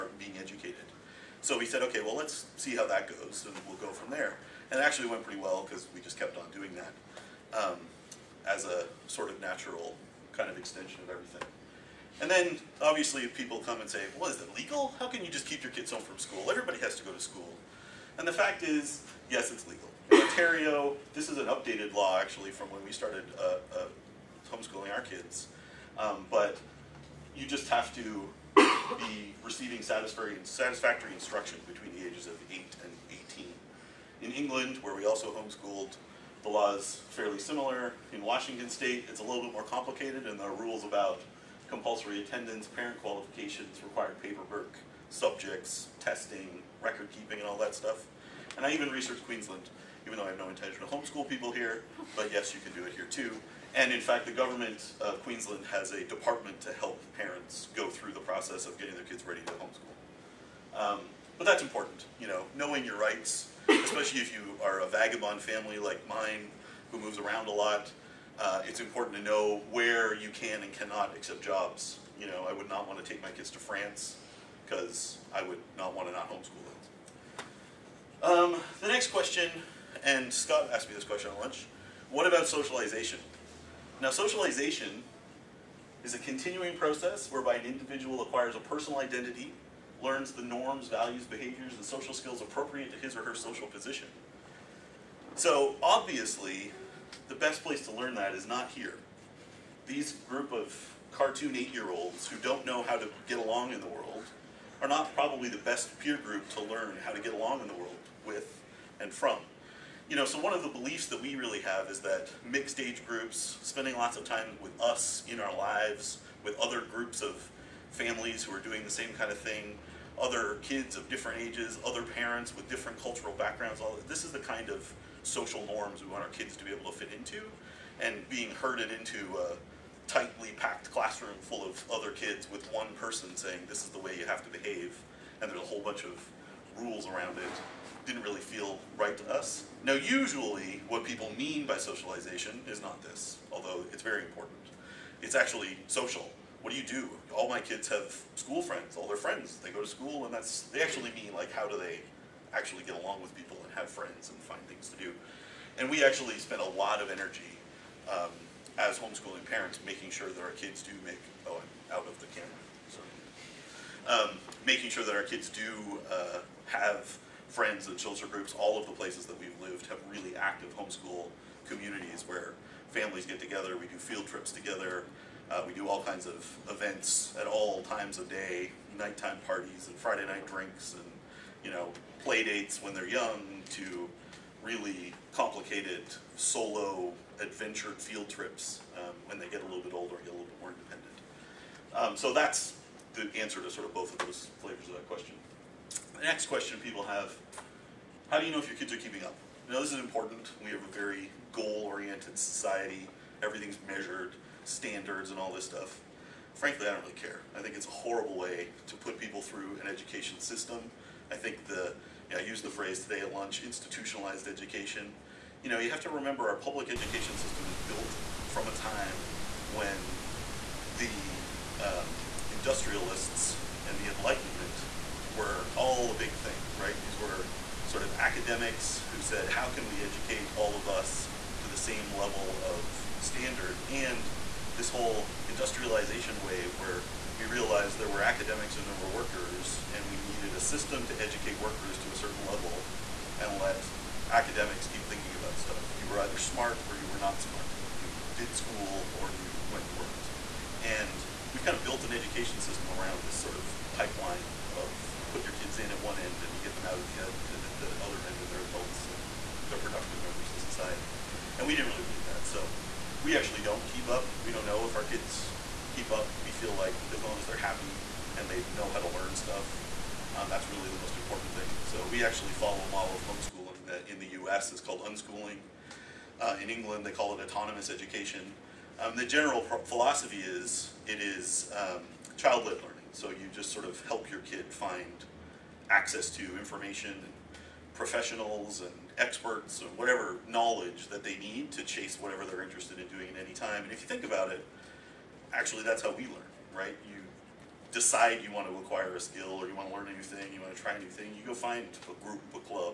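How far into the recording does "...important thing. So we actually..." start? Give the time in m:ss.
4:31.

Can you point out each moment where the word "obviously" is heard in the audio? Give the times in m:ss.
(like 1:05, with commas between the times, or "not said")
0:12, 1:35.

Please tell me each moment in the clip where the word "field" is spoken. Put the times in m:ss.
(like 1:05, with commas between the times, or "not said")
2:53, 3:07.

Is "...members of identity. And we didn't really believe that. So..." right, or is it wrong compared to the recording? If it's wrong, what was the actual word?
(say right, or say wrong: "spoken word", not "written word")
wrong: "society", not "identity".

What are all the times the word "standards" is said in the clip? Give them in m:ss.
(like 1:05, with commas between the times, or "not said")
3:24, 3:53.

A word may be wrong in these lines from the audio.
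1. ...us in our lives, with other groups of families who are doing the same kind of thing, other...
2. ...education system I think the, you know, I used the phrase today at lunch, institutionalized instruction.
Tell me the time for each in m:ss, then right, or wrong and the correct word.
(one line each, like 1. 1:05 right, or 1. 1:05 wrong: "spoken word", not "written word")
1. 1:54 right
2. 3:29 wrong: "education", not "instruction".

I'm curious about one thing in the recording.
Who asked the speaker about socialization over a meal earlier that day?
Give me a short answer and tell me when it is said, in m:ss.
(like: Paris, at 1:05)
Scott, at 1:20.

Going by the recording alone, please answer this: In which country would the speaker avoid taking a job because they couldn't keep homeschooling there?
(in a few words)
France.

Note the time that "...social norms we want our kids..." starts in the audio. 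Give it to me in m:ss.
2:05.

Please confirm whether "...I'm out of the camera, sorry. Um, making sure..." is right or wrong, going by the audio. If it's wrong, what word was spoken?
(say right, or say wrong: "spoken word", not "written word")
right.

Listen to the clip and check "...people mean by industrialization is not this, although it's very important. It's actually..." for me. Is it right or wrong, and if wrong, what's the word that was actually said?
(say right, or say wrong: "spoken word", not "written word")
wrong: "socialization", not "industrialization".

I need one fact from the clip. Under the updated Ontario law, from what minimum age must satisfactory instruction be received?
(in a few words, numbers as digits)
8.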